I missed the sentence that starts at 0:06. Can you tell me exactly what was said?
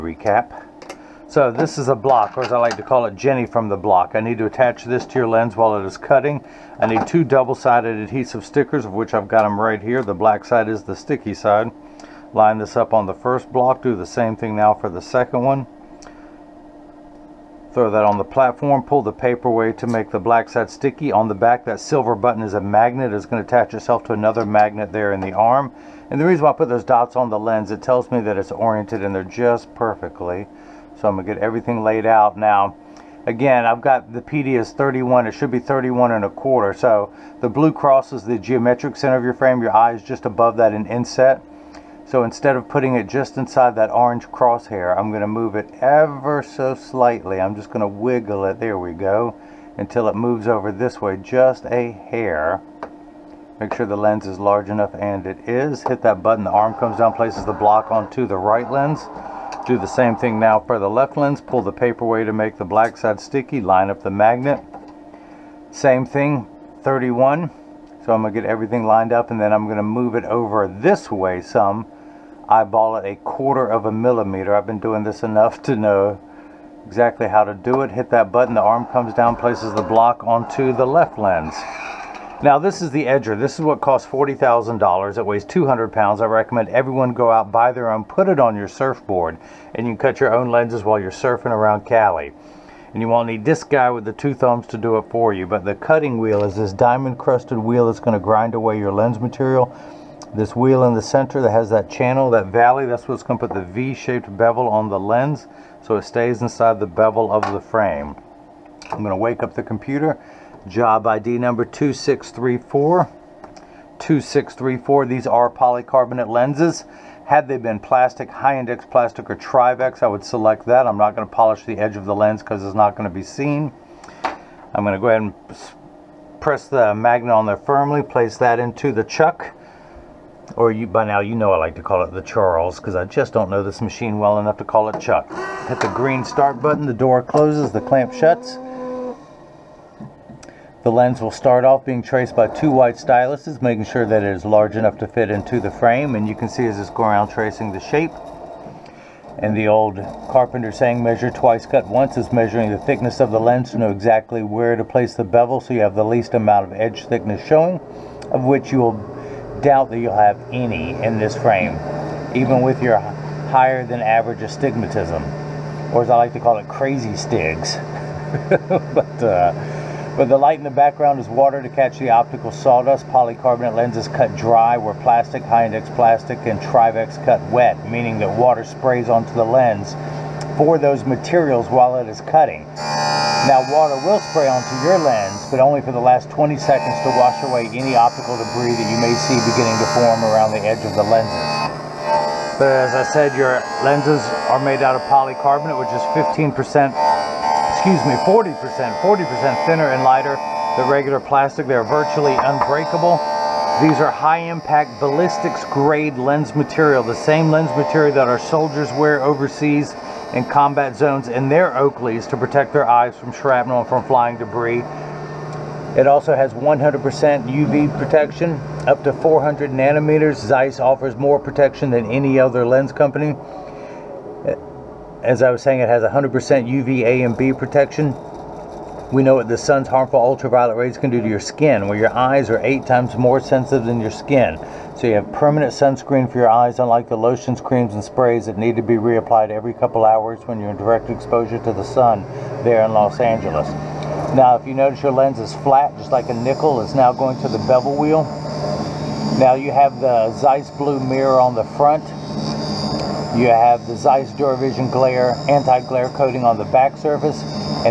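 I need two double-sided adhesive stickers, of which I've got them right here.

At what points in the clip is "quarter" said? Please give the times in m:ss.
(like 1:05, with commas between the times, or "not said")
0:36, 1:13.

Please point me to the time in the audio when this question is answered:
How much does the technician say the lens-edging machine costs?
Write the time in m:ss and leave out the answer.
1:24.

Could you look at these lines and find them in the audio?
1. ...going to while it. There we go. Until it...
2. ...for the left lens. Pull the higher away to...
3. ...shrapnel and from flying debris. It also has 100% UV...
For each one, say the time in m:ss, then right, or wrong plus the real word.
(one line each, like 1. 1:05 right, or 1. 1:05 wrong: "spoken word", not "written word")
1. 0:47 wrong: "wiggle", not "while"
2. 1:00 wrong: "paper", not "higher"
3. 3:33 right.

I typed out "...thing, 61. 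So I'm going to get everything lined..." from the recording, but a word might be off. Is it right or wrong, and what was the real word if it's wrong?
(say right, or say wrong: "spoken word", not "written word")
wrong: "31", not "61".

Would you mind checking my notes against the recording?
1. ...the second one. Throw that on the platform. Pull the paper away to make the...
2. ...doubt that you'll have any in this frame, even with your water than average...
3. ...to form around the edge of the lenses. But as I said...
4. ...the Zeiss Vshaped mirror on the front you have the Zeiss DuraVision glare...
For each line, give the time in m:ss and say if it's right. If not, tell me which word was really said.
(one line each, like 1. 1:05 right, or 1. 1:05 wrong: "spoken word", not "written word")
1. 0:14 right
2. 2:39 wrong: "higher", not "water"
3. 3:09 right
4. 4:10 wrong: "Blue", not "Vshaped".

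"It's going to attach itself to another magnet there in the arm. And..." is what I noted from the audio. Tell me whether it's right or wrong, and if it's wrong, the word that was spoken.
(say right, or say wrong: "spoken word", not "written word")
right.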